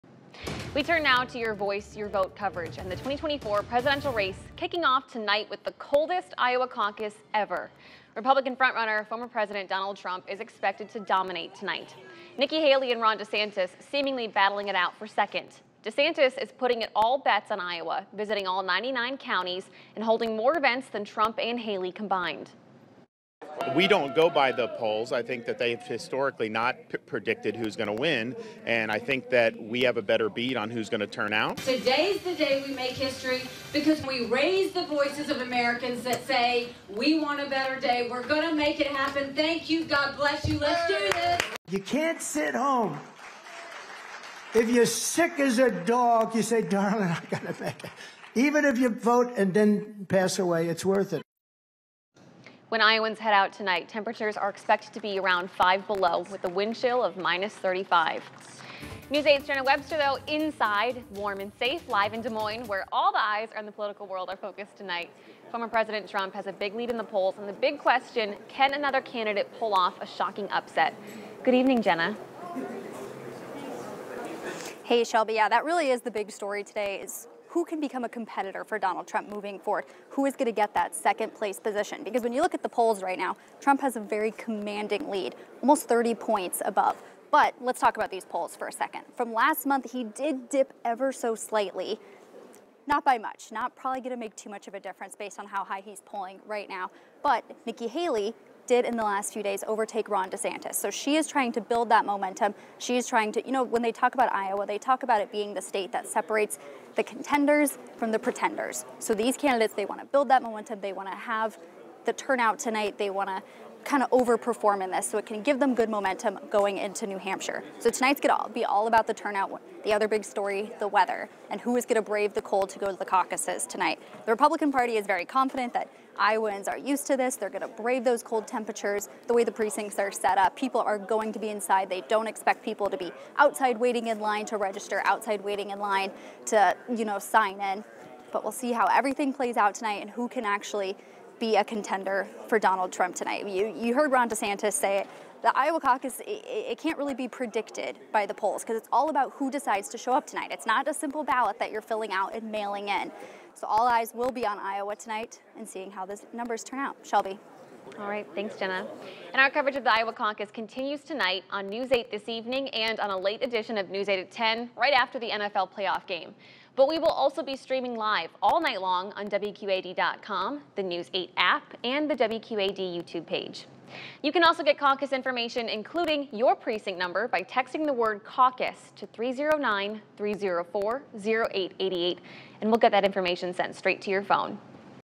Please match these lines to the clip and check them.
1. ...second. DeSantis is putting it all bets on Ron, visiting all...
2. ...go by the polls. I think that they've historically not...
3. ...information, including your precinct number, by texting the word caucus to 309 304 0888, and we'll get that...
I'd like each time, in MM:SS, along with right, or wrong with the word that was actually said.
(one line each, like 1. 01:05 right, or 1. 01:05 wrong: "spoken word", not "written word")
1. 00:15 wrong: "Iowa", not "Ron"
2. 00:24 right
3. 02:55 right.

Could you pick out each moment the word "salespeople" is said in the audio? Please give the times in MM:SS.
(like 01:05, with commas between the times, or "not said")
not said.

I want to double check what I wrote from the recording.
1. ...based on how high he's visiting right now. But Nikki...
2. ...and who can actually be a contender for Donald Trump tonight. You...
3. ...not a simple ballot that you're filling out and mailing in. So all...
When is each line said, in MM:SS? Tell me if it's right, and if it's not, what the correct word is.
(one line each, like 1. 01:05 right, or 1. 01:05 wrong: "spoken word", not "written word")
1. 01:35 wrong: "polling", not "visiting"
2. 02:20 right
3. 02:30 right.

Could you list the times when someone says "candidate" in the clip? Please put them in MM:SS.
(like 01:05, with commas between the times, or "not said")
01:09, 01:49.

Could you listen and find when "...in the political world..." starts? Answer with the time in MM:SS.
01:03.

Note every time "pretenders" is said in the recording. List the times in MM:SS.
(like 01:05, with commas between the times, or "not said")
01:48.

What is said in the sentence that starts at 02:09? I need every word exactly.
The way the precincts are set up, people are going to be inside.